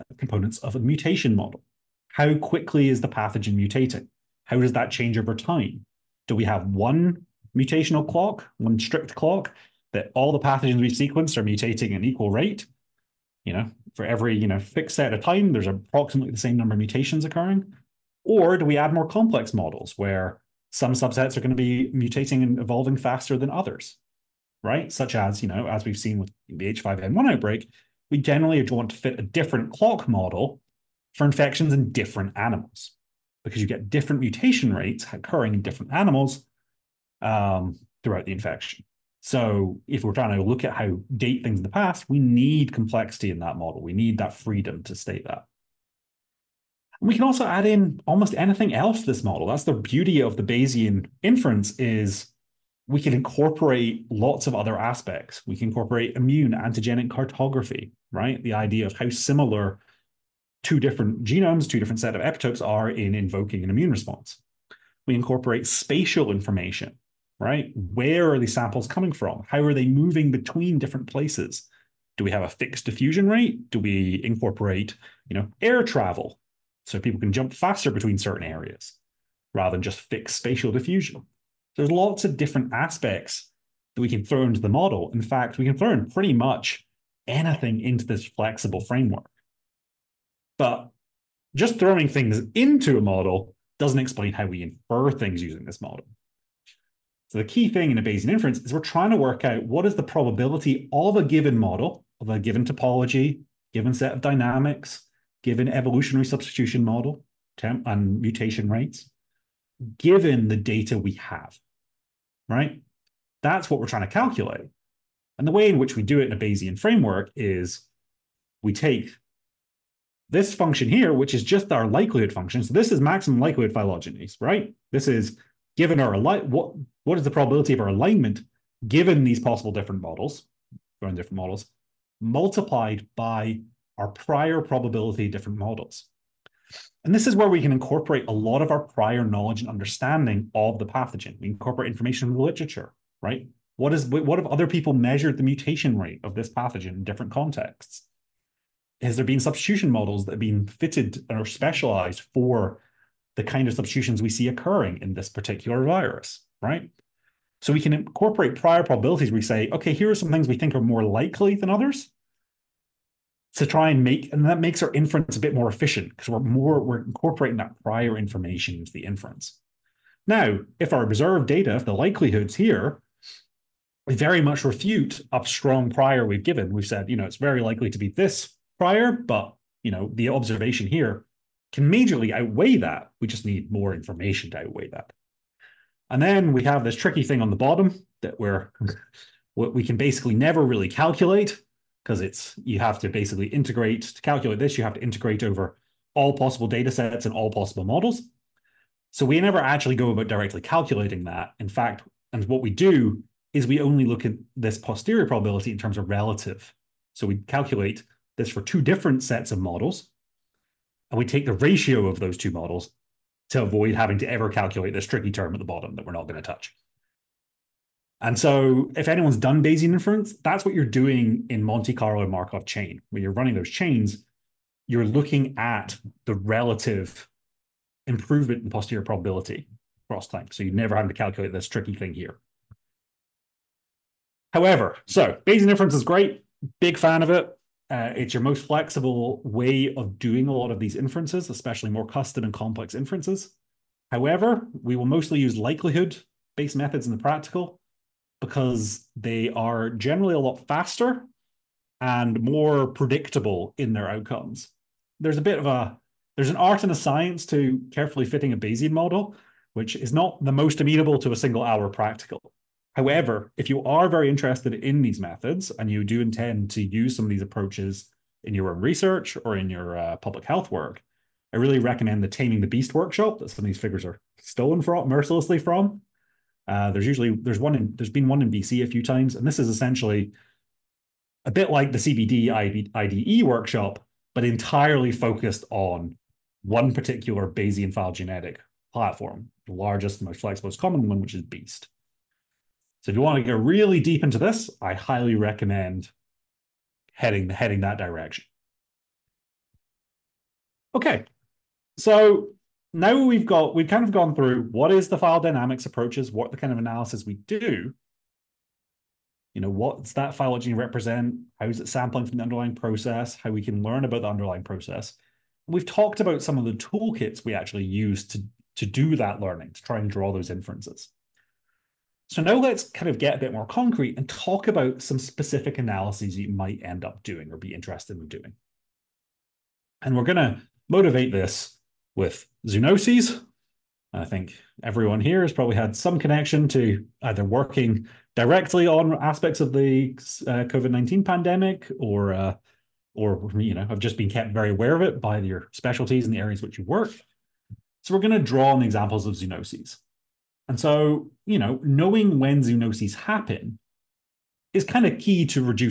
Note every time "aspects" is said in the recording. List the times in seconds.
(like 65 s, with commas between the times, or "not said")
54 s, 82 s, 339 s.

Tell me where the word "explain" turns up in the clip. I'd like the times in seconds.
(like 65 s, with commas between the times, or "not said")
93 s.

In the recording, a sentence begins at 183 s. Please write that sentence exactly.
We just need more information to outweigh that.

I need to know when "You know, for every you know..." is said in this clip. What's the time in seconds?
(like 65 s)
13 s.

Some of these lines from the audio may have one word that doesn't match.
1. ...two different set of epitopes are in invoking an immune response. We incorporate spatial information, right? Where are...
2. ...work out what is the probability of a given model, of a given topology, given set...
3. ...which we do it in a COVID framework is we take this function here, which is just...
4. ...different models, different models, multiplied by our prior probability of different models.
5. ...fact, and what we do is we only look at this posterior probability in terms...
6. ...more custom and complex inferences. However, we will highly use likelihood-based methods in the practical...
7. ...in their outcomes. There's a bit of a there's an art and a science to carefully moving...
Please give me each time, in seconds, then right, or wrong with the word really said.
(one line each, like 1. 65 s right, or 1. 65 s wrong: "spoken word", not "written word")
1. 61 s right
2. 99 s right
3. 115 s wrong: "Bayesian", not "COVID"
4. 129 s right
5. 201 s right
6. 241 s wrong: "mostly", not "highly"
7. 253 s wrong: "fitting", not "moving".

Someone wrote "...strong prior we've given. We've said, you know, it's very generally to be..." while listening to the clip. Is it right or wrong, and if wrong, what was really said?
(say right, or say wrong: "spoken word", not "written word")
wrong: "likely", not "generally".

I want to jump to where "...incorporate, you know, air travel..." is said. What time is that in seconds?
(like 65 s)
74 s.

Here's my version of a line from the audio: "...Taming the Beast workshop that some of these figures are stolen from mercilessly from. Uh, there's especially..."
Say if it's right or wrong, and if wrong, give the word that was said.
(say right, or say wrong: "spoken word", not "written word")
wrong: "usually", not "especially".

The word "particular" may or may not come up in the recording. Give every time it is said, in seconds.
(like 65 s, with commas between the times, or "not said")
155 s, 286 s.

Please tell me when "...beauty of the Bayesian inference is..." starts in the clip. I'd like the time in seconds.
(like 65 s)
49 s.